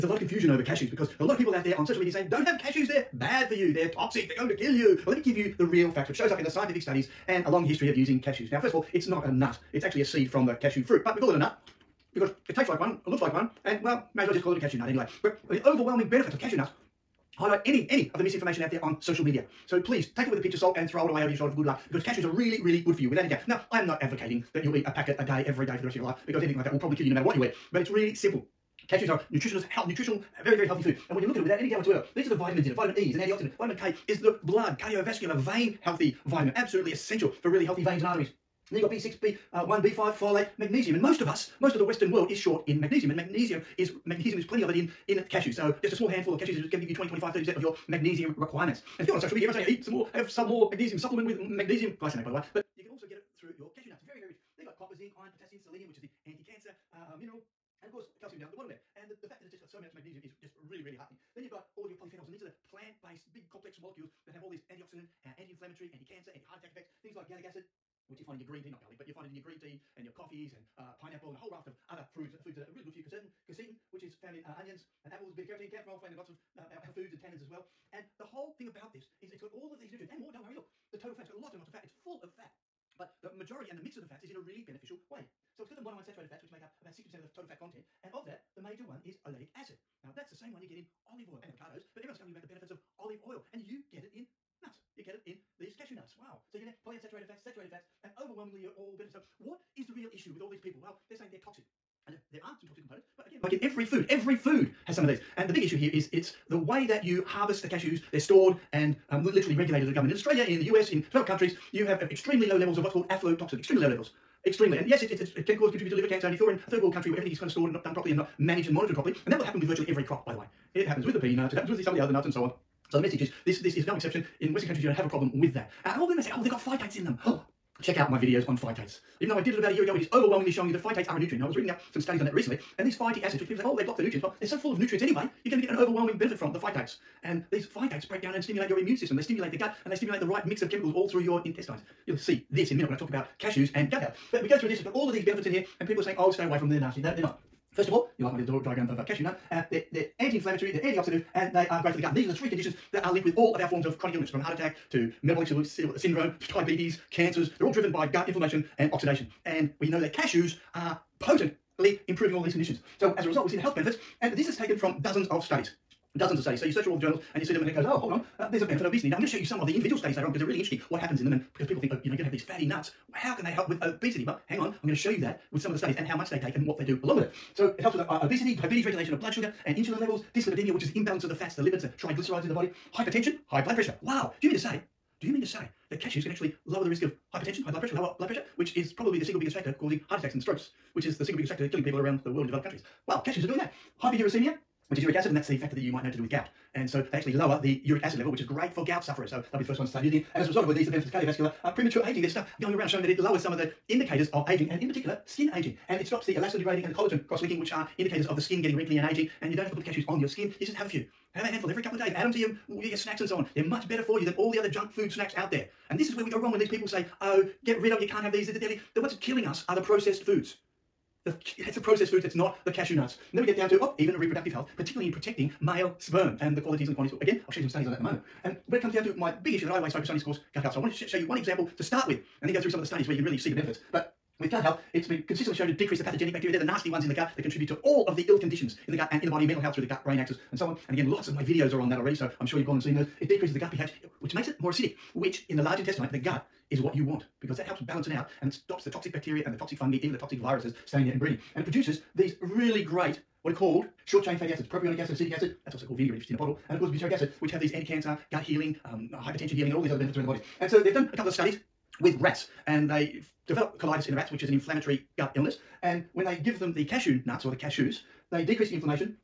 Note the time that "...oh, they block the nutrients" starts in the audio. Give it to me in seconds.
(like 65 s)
133 s.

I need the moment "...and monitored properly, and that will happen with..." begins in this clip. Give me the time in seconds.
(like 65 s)
118 s.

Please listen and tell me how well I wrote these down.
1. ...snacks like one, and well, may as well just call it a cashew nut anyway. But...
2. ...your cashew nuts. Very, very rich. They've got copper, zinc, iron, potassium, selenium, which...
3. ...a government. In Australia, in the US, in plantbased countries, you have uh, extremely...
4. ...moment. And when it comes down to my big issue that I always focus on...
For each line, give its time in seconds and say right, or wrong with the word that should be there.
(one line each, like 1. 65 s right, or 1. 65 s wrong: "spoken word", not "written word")
1. 13 s wrong: "looks", not "snacks"
2. 53 s right
3. 109 s wrong: "developed", not "plantbased"
4. 228 s right.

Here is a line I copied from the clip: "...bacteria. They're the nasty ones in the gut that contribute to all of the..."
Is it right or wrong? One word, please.
right.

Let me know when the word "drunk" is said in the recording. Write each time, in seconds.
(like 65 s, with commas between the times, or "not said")
not said.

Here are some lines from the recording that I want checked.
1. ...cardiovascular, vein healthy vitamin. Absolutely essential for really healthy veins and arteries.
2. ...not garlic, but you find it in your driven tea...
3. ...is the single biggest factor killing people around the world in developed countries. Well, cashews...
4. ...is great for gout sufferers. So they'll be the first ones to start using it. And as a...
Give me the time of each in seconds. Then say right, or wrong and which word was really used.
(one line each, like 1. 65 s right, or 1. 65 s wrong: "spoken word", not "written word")
1. 34 s right
2. 68 s wrong: "green", not "driven"
3. 191 s right
4. 198 s right.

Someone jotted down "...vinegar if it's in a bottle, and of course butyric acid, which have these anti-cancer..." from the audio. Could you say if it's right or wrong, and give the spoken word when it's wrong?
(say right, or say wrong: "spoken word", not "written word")
right.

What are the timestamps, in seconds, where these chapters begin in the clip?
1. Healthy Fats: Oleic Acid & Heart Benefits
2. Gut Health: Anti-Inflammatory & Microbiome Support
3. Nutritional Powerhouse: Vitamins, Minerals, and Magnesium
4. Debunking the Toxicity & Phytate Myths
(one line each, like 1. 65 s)
1. 125 s
2. 219 s
3. 78 s
4. 172 s.